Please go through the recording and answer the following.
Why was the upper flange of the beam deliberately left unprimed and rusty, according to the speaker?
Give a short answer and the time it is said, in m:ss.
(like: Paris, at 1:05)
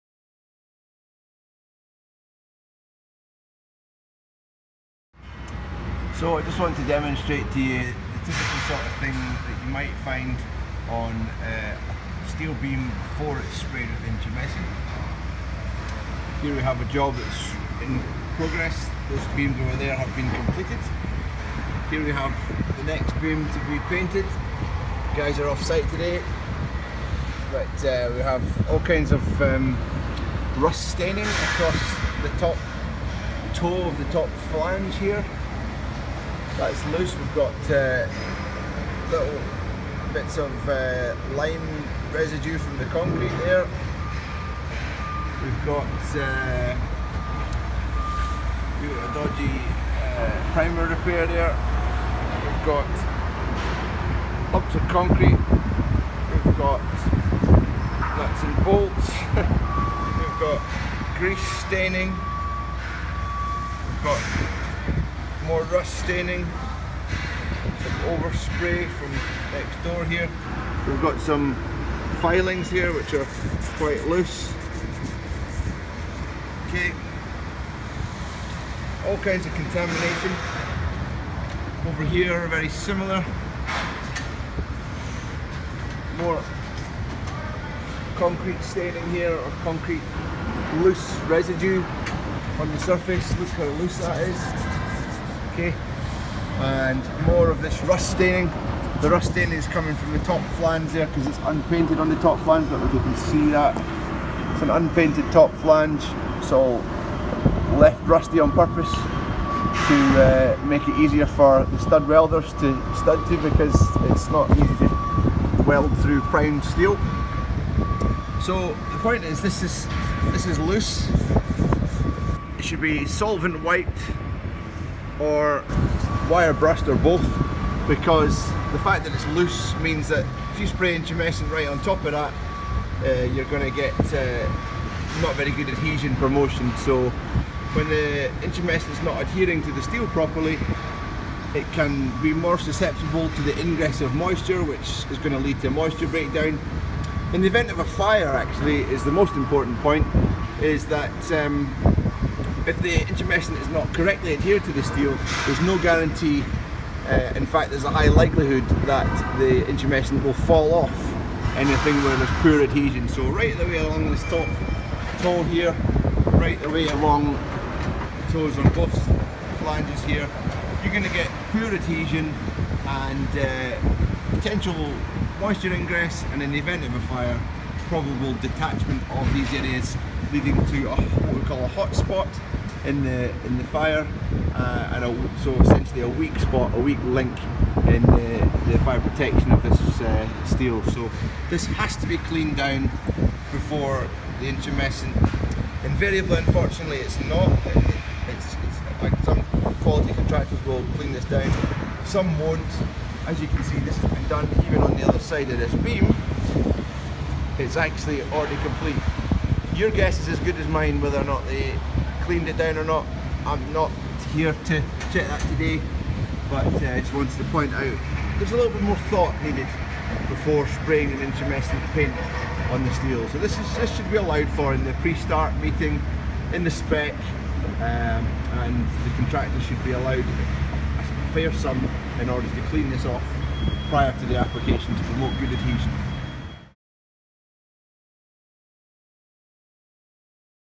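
for the stud welders, at 1:51.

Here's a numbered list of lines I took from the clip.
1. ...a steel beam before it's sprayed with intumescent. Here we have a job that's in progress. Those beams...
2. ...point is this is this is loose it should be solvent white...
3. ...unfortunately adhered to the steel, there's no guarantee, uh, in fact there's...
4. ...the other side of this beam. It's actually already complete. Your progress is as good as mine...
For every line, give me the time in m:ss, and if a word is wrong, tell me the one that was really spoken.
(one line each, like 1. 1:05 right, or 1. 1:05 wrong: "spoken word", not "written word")
1. 0:11 right
2. 1:58 right
3. 2:33 wrong: "correctly", not "unfortunately"
4. 3:24 wrong: "guess", not "progress".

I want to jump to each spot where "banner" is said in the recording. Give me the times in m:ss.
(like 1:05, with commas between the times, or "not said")
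not said.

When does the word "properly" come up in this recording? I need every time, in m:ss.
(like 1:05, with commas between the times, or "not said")
2:20.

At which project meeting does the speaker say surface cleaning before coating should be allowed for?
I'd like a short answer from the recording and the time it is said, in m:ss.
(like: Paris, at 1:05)
pre-start meeting, at 3:44.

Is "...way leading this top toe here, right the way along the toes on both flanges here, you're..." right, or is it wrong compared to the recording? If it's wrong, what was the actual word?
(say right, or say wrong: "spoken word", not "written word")
wrong: "along", not "leading".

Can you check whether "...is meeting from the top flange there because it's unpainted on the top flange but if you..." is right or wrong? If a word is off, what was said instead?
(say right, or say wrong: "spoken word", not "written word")
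wrong: "coming", not "meeting".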